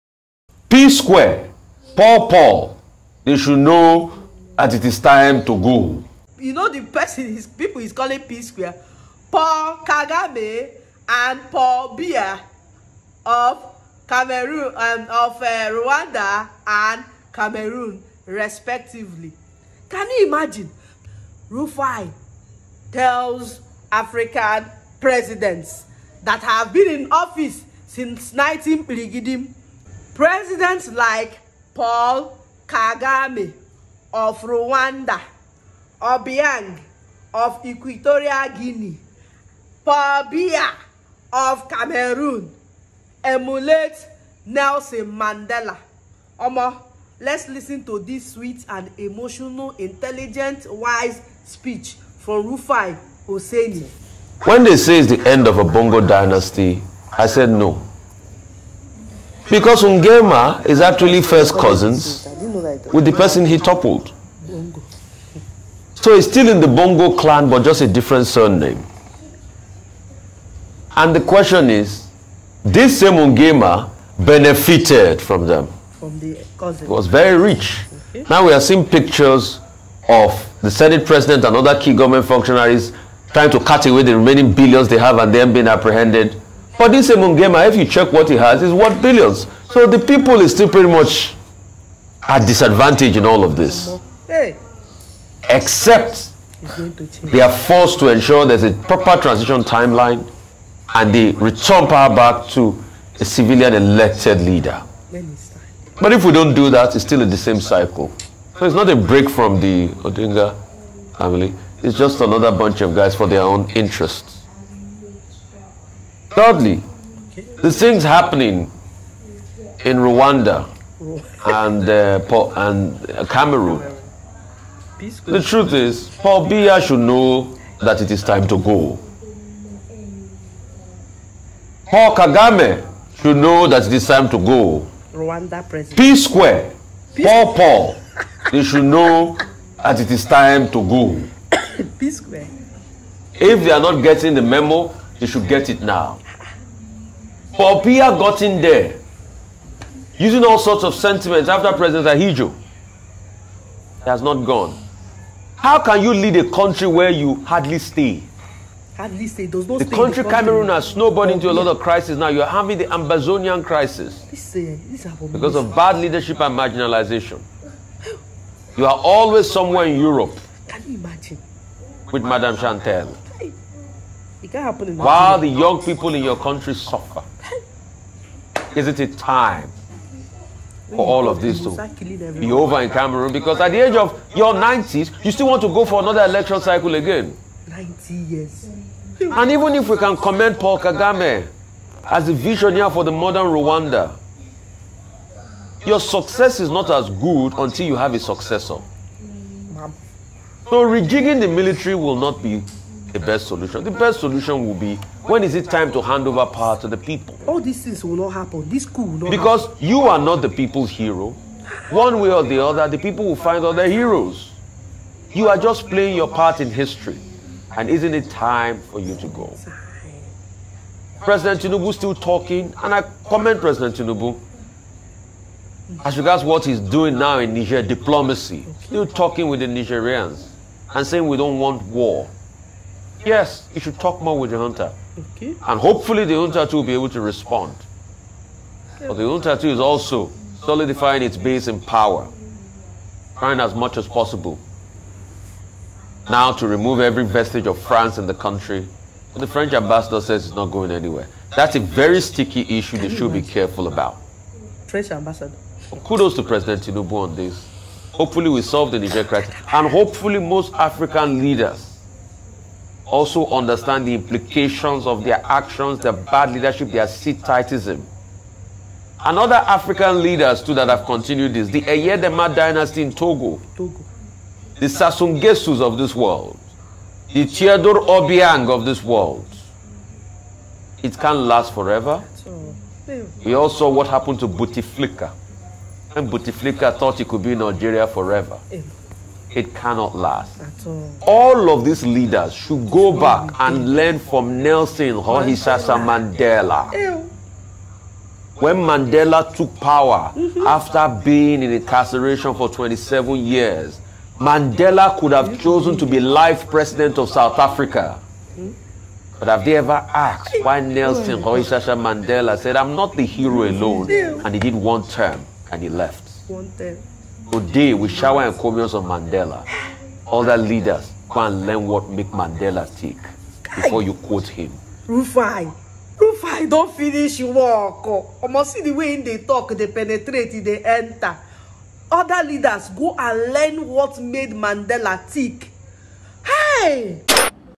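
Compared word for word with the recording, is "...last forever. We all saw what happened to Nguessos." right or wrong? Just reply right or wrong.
wrong.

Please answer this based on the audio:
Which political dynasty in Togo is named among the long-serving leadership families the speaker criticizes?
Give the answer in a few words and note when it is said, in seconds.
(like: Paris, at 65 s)
Eyadema dynasty, at 271 s.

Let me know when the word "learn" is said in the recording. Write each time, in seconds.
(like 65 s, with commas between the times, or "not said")
293 s, 321 s, 333 s.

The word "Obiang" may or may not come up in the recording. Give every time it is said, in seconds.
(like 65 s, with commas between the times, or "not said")
36 s, 278 s.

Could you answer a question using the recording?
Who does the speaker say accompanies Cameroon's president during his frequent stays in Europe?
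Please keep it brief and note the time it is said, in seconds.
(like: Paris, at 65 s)
Madame Chantal, at 172 s.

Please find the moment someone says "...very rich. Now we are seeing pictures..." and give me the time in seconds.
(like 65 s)
77 s.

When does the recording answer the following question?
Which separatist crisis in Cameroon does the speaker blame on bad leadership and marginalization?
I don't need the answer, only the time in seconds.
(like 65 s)
162 s.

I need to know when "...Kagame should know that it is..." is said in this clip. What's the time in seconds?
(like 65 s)
132 s.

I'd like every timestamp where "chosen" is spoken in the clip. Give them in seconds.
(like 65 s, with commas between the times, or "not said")
305 s.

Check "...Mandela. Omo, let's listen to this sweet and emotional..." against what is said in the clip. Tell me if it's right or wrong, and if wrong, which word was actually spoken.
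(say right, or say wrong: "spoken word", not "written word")
right.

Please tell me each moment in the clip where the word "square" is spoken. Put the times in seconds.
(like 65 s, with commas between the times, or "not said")
0 s, 8 s, 136 s, 142 s.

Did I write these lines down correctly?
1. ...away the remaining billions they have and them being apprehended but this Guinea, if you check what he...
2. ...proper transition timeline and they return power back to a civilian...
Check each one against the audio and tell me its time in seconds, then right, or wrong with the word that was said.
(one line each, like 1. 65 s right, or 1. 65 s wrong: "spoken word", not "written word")
1. 83 s wrong: "Nguema", not "Guinea"
2. 98 s right.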